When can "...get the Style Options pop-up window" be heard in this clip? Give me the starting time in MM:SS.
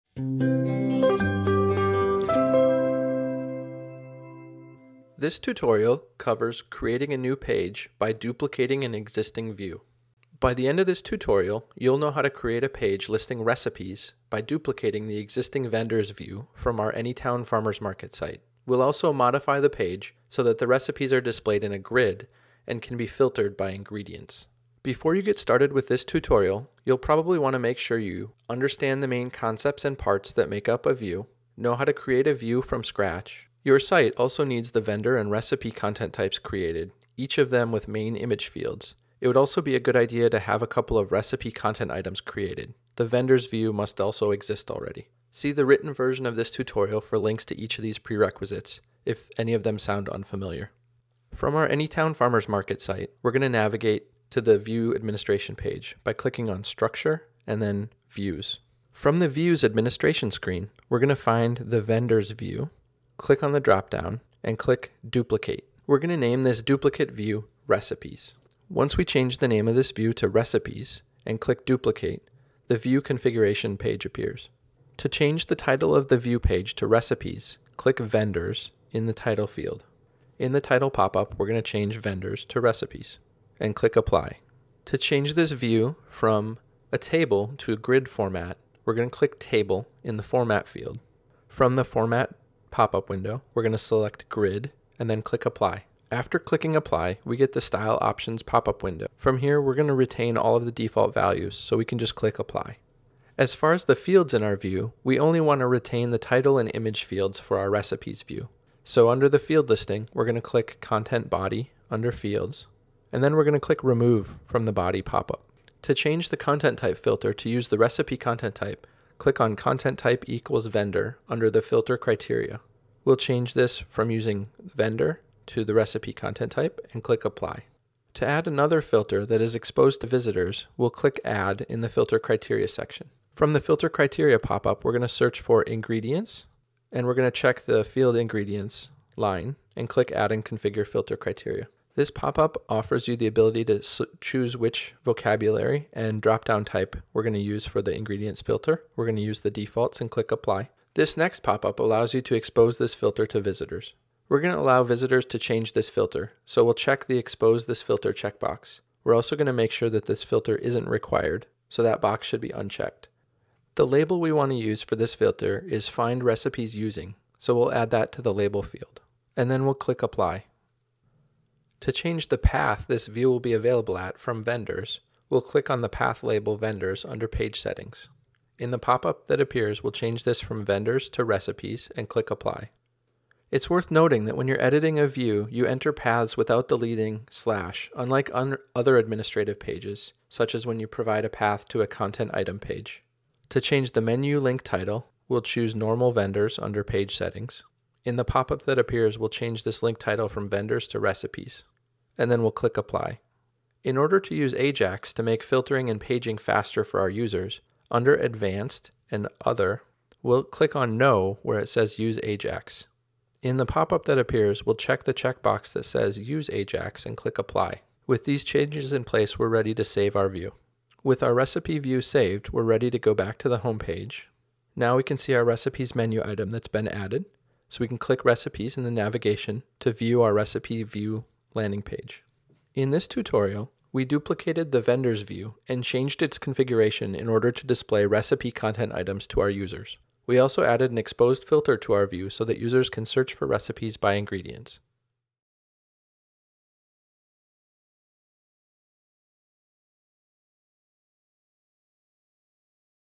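01:37.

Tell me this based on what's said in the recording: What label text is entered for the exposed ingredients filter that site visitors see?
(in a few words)
Find recipes using.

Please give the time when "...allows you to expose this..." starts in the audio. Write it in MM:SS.
02:31.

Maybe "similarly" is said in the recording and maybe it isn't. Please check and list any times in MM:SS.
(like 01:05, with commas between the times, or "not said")
not said.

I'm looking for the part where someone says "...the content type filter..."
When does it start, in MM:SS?
01:56.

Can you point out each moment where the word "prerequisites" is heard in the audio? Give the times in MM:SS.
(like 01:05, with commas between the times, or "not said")
00:47.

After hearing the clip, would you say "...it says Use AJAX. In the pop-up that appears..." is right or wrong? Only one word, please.
right.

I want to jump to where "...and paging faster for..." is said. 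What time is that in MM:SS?
03:25.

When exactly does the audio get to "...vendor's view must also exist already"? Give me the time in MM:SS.
00:43.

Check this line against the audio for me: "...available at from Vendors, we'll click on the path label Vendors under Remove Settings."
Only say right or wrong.
wrong.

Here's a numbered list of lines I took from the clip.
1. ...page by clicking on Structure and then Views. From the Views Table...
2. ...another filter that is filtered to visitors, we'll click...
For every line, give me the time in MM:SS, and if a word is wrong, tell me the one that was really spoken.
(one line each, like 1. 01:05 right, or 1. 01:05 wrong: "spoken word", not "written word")
1. 00:55 wrong: "Administration", not "Table"
2. 02:08 wrong: "exposed", not "filtered".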